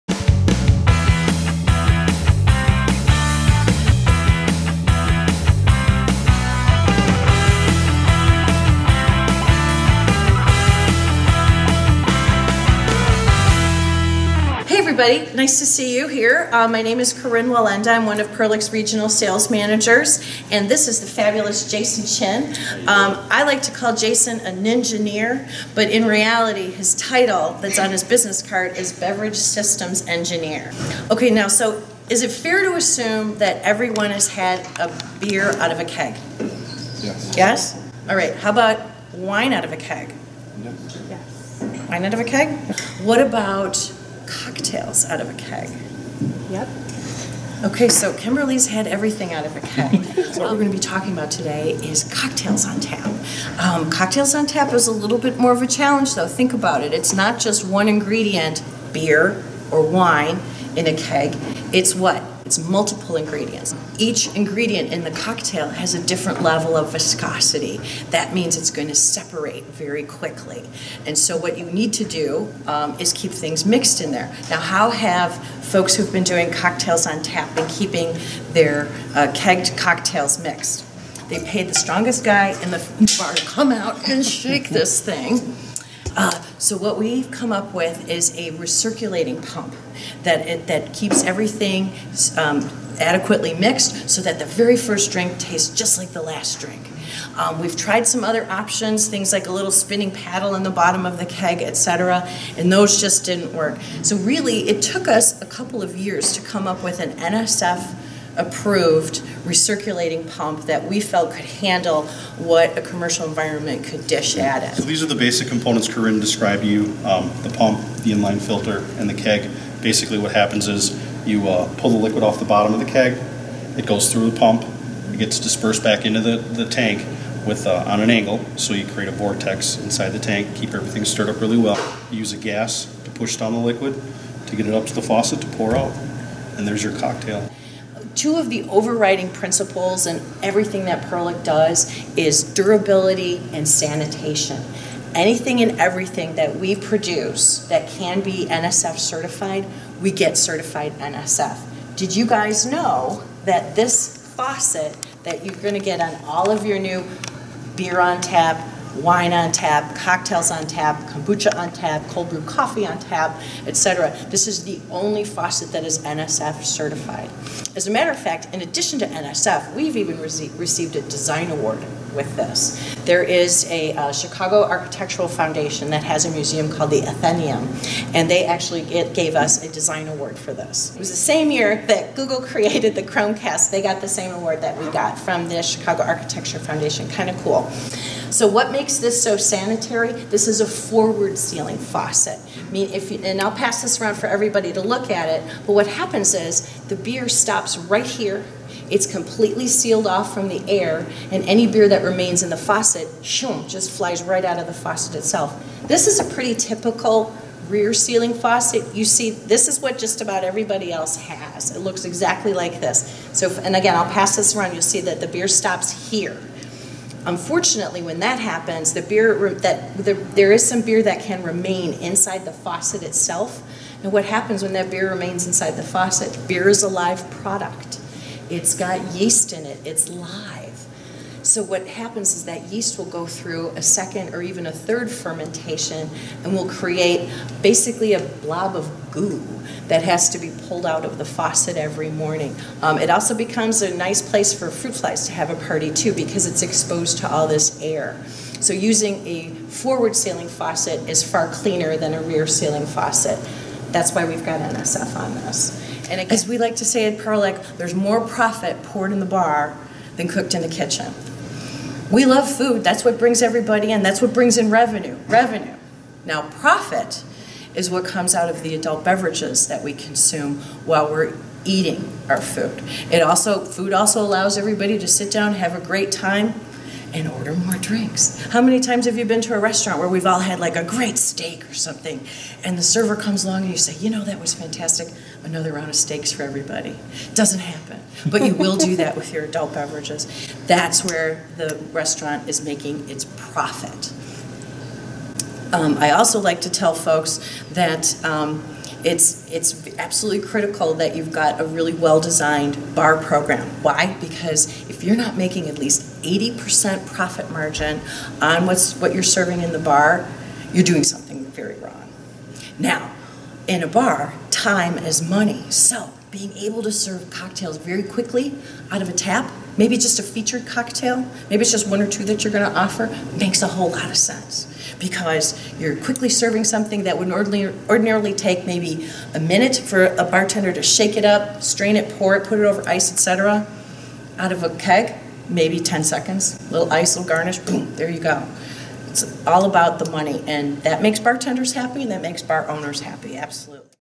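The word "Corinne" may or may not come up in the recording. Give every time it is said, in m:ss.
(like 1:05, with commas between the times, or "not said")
0:17, 1:55.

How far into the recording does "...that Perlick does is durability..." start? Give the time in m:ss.
2:20.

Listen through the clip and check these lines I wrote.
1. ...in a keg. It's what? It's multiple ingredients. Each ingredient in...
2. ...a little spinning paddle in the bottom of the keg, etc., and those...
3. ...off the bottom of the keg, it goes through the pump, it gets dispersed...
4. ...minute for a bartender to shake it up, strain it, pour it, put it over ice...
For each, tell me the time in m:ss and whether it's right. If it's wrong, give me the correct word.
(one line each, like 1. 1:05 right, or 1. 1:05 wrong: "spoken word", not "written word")
1. 1:00 right
2. 1:39 right
3. 2:02 right
4. 5:29 right.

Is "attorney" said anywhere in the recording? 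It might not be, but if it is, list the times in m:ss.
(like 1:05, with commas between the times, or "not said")
not said.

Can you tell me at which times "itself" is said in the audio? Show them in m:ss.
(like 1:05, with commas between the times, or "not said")
3:25, 3:43.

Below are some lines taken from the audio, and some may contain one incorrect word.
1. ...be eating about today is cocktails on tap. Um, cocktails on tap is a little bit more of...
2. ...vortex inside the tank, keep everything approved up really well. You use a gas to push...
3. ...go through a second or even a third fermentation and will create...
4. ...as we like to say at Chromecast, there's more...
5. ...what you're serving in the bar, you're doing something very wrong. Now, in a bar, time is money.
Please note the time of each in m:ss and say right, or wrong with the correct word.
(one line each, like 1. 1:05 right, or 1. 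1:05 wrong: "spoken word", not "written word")
1. 0:50 wrong: "talking", not "eating"
2. 2:09 wrong: "stirred", not "approved"
3. 3:53 right
4. 4:16 wrong: "Perlick", not "Chromecast"
5. 5:08 right.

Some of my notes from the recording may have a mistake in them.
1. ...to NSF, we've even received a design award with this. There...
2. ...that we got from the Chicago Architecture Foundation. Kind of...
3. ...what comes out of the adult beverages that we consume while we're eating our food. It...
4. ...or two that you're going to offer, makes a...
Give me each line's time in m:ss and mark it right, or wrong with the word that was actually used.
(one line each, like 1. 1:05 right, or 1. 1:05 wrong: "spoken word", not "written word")
1. 2:48 right
2. 3:04 right
3. 4:27 right
4. 5:22 right.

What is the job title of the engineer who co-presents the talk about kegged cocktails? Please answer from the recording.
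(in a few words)
Beverage Systems Engineer.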